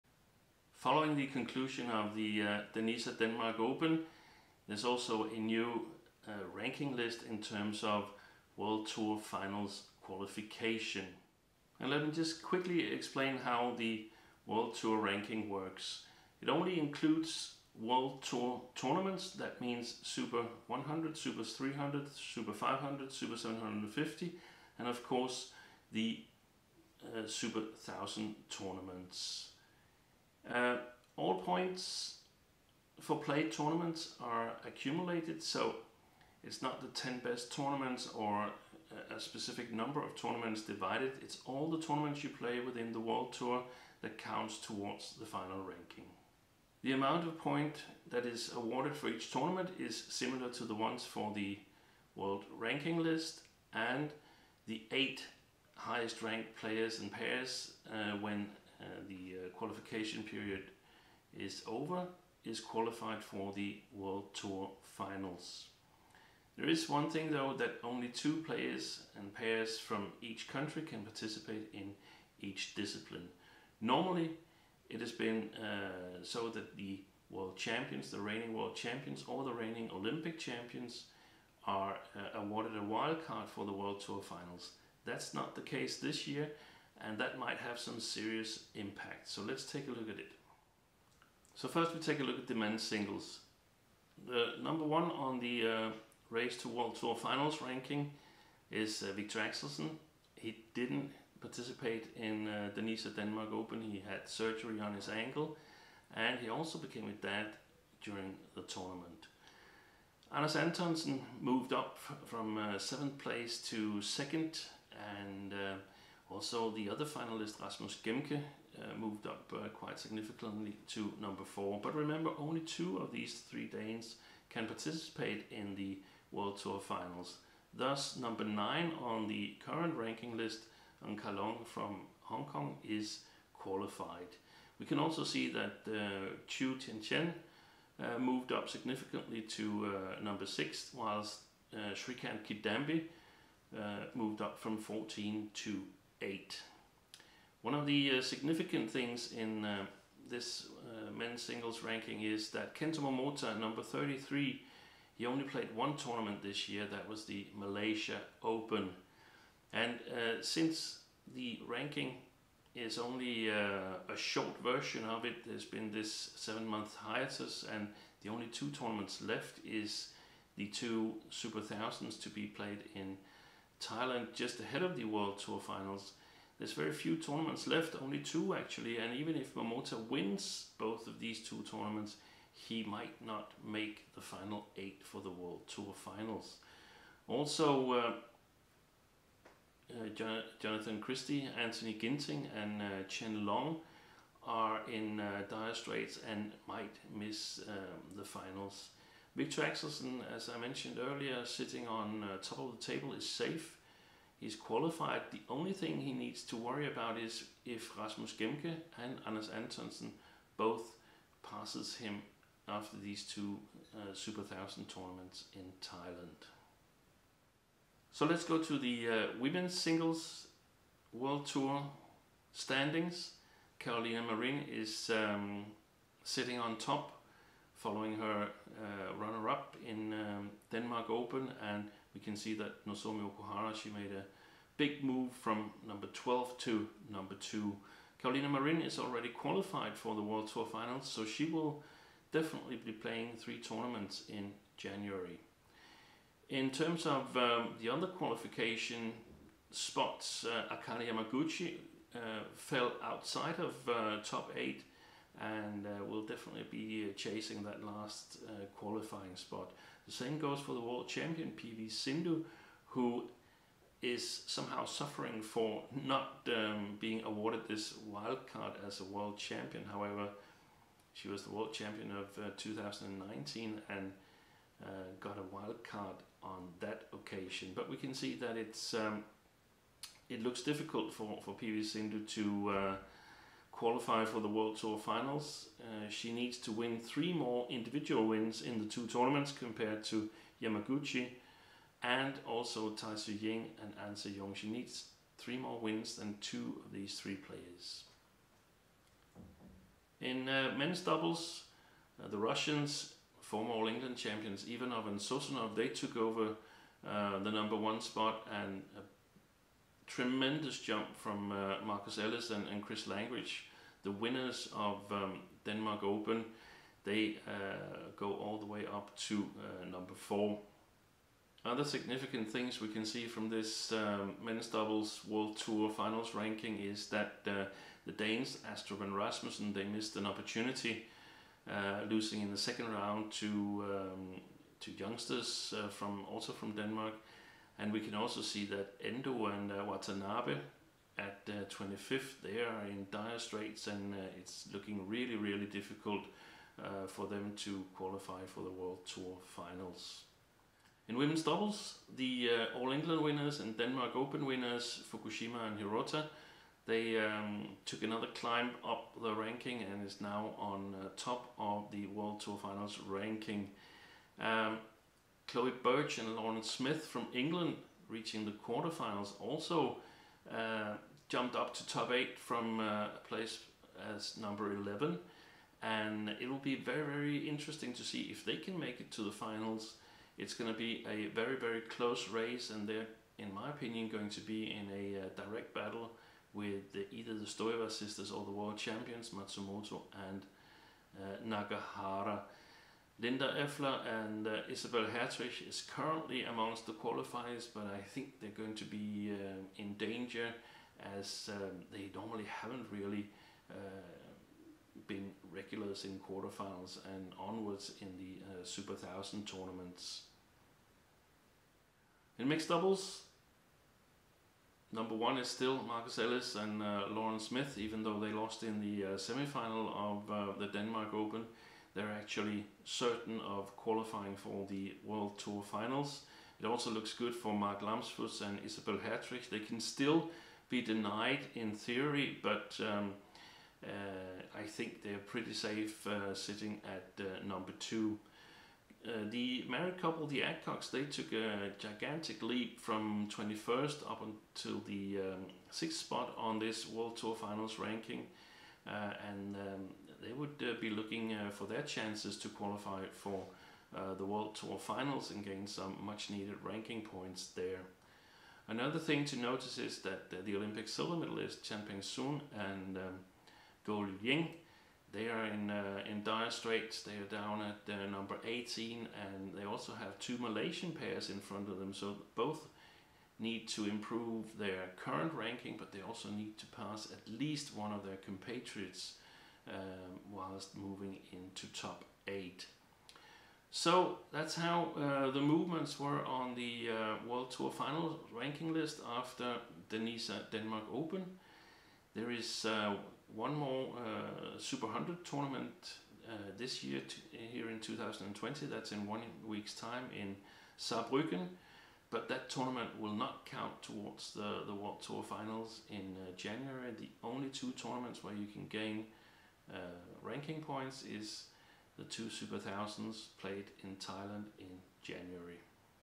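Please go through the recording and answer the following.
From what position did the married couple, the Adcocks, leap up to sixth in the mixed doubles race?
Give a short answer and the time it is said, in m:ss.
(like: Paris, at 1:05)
21st, at 7:23.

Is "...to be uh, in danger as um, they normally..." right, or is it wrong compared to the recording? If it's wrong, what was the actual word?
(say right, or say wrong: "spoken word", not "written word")
right.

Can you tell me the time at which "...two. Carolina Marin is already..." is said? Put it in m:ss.
3:57.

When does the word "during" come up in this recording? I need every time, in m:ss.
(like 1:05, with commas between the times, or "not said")
1:48.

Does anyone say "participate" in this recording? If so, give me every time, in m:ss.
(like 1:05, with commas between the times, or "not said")
1:11, 1:41, 2:04.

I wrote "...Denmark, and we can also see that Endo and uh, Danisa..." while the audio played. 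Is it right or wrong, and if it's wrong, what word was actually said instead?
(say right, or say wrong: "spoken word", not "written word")
wrong: "Watanabe", not "Danisa".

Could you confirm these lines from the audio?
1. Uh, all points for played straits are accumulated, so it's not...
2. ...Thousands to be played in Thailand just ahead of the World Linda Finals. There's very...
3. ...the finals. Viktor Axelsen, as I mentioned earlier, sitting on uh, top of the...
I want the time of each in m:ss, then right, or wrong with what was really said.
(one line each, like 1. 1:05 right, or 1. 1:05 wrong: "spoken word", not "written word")
1. 0:30 wrong: "tournaments", not "straits"
2. 2:51 wrong: "Tour", not "Linda"
3. 3:18 right.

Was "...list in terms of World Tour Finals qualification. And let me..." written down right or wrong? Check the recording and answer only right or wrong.
right.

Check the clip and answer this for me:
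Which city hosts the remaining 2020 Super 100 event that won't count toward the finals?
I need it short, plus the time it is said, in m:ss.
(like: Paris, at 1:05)
Saarbrücken, at 8:20.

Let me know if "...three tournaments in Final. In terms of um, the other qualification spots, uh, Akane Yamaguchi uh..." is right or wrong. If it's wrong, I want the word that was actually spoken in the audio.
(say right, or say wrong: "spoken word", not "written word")
wrong: "January", not "Final".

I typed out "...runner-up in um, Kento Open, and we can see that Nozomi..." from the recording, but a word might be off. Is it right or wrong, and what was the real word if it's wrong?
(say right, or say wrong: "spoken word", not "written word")
wrong: "Denmark", not "Kento".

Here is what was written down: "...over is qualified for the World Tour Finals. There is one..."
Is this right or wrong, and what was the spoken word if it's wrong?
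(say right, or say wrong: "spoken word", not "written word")
right.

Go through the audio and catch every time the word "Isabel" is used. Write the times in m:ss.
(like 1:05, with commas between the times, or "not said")
6:34, 7:08.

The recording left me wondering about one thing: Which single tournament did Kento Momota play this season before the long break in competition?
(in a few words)
Malaysia Open.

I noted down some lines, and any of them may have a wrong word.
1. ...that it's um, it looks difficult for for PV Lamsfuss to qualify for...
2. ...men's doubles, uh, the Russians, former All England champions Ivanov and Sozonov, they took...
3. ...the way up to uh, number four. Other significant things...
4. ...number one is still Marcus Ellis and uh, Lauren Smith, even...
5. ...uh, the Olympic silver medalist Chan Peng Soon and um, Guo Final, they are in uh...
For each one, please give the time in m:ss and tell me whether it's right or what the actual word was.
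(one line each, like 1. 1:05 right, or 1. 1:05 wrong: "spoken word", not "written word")
1. 4:38 wrong: "Sindhu", not "Lamsfuss"
2. 5:00 right
3. 5:18 right
4. 6:54 right
5. 7:40 wrong: "Ying", not "Final".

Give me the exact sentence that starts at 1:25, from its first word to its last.
That's not the case this year and that might have some serious impact.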